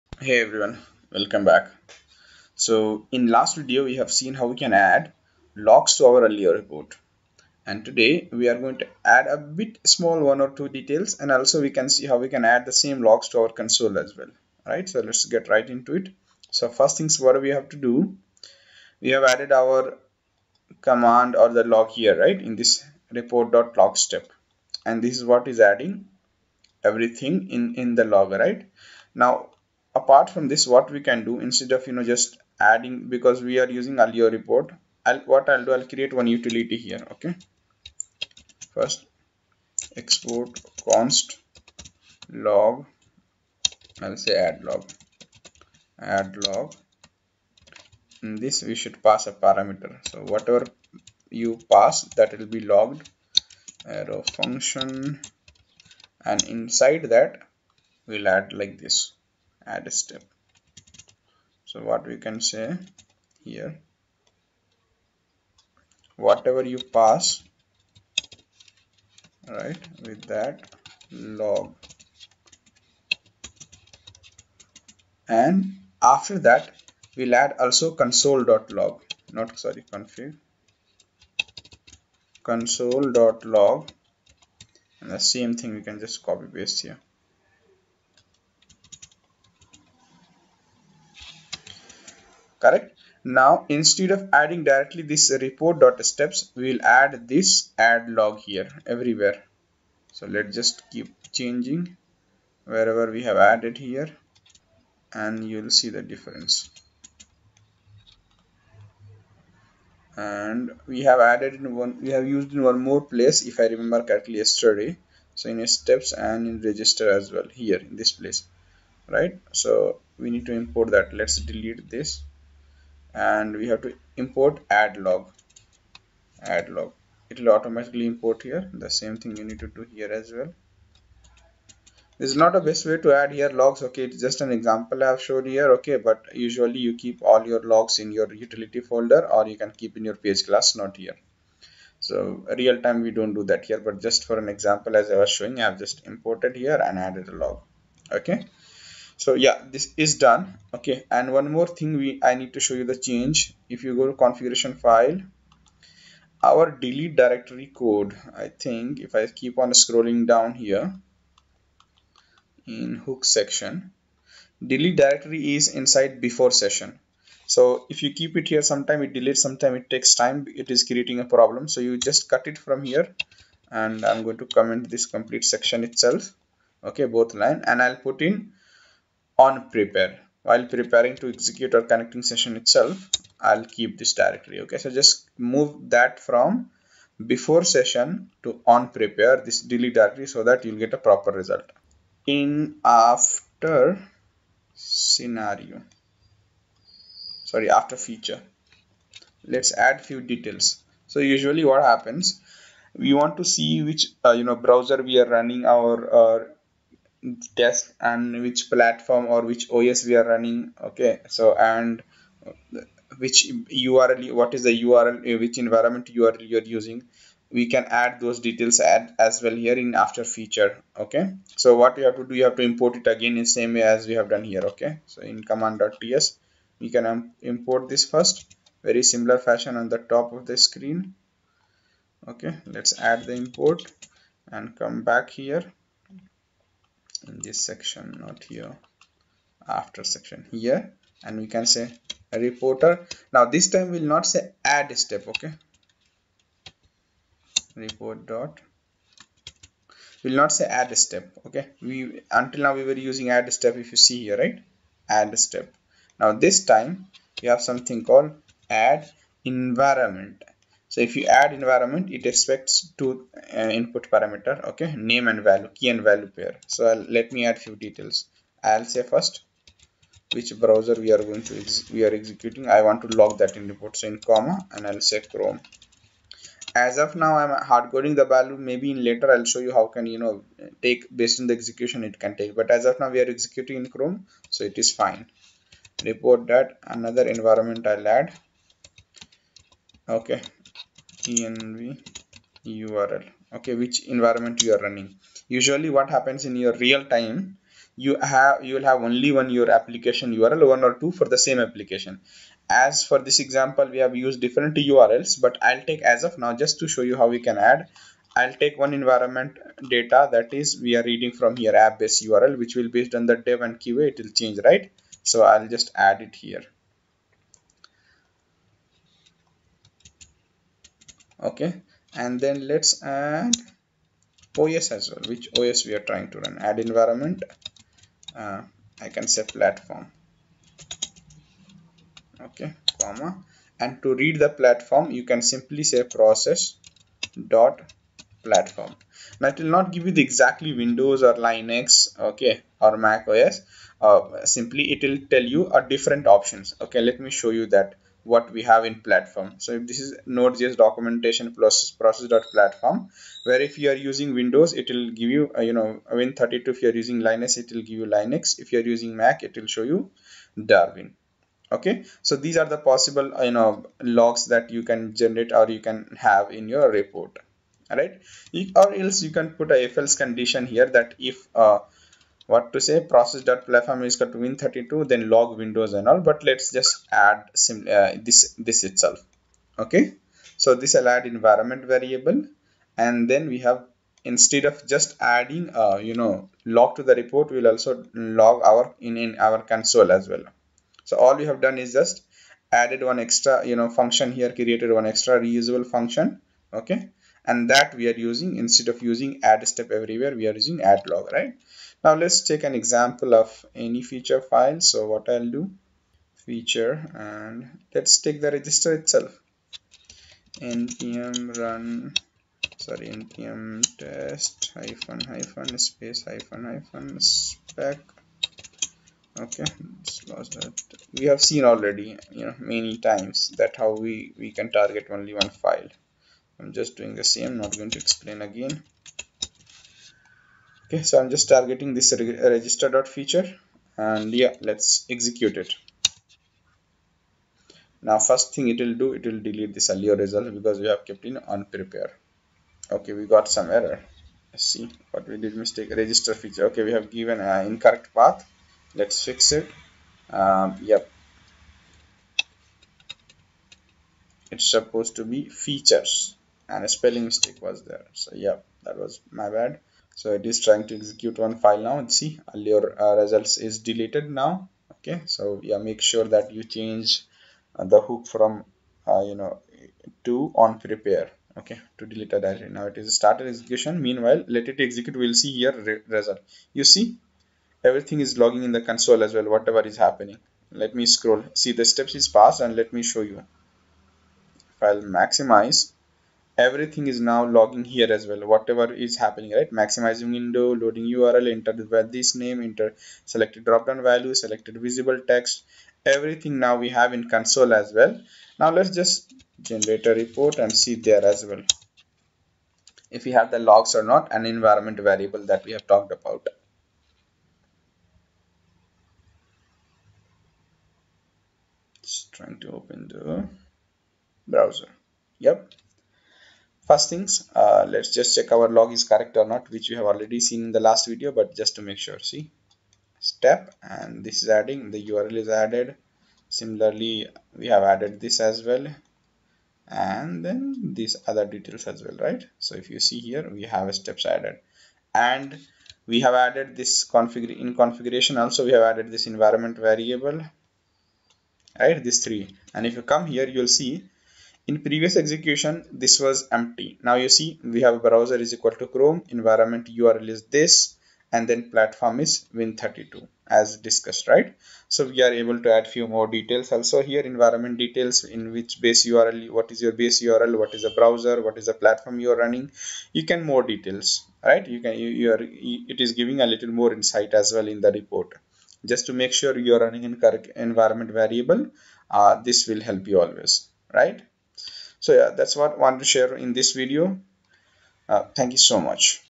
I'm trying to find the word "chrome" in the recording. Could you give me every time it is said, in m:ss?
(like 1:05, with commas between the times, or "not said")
4:35, 4:43, 9:08.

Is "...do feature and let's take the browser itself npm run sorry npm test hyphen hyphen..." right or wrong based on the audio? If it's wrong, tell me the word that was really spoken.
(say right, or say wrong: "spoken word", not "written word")
wrong: "register", not "browser".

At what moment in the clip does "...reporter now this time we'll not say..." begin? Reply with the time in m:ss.
4:02.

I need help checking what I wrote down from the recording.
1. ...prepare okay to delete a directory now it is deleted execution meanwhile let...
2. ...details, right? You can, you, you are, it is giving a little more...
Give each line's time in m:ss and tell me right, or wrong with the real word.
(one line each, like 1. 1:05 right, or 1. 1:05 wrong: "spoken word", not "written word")
1. 7:50 wrong: "started", not "deleted"
2. 9:23 right.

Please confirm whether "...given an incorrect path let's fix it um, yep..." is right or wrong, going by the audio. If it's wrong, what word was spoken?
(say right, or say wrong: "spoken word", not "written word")
right.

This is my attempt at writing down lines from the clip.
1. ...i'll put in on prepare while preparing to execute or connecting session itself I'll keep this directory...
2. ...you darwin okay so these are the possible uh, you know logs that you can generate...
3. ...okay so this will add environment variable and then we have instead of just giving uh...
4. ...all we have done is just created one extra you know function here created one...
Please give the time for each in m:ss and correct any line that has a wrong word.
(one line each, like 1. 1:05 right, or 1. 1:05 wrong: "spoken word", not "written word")
1. 2:57 right
2. 5:59 right
3. 6:19 wrong: "adding", not "giving"
4. 6:31 wrong: "added", not "created".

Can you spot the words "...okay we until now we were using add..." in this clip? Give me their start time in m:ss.
4:11.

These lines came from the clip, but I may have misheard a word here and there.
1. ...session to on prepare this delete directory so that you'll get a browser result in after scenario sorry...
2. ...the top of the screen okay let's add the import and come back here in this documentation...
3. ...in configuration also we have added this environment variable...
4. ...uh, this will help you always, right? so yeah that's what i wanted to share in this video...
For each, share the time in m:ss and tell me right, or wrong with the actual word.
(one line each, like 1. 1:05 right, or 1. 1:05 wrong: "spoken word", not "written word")
1. 3:07 wrong: "proper", not "browser"
2. 3:49 wrong: "section", not "documentation"
3. 8:57 right
4. 9:32 right.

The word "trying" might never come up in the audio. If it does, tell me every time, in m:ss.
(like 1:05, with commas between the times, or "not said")
5:26, 7:40, 8:32.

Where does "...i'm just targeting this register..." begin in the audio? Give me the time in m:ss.
7:11.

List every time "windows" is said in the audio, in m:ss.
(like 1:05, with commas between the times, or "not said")
5:40, 5:54, 6:15, 8:10.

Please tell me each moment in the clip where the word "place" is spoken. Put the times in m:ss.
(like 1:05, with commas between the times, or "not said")
1:53, 1:58.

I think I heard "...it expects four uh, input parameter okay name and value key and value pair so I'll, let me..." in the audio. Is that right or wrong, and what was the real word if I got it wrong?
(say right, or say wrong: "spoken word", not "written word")
wrong: "two", not "four".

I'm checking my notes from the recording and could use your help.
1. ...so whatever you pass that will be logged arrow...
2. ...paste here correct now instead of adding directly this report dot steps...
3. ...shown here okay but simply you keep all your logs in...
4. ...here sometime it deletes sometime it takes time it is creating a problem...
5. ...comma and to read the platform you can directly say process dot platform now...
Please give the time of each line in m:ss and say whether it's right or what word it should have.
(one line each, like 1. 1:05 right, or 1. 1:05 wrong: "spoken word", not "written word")
1. 0:50 right
2. 1:26 right
3. 2:15 wrong: "usually", not "simply"
4. 2:48 right
5. 5:33 wrong: "simply", not "directly".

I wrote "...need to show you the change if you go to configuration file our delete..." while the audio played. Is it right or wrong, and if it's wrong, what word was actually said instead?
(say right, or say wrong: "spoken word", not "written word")
right.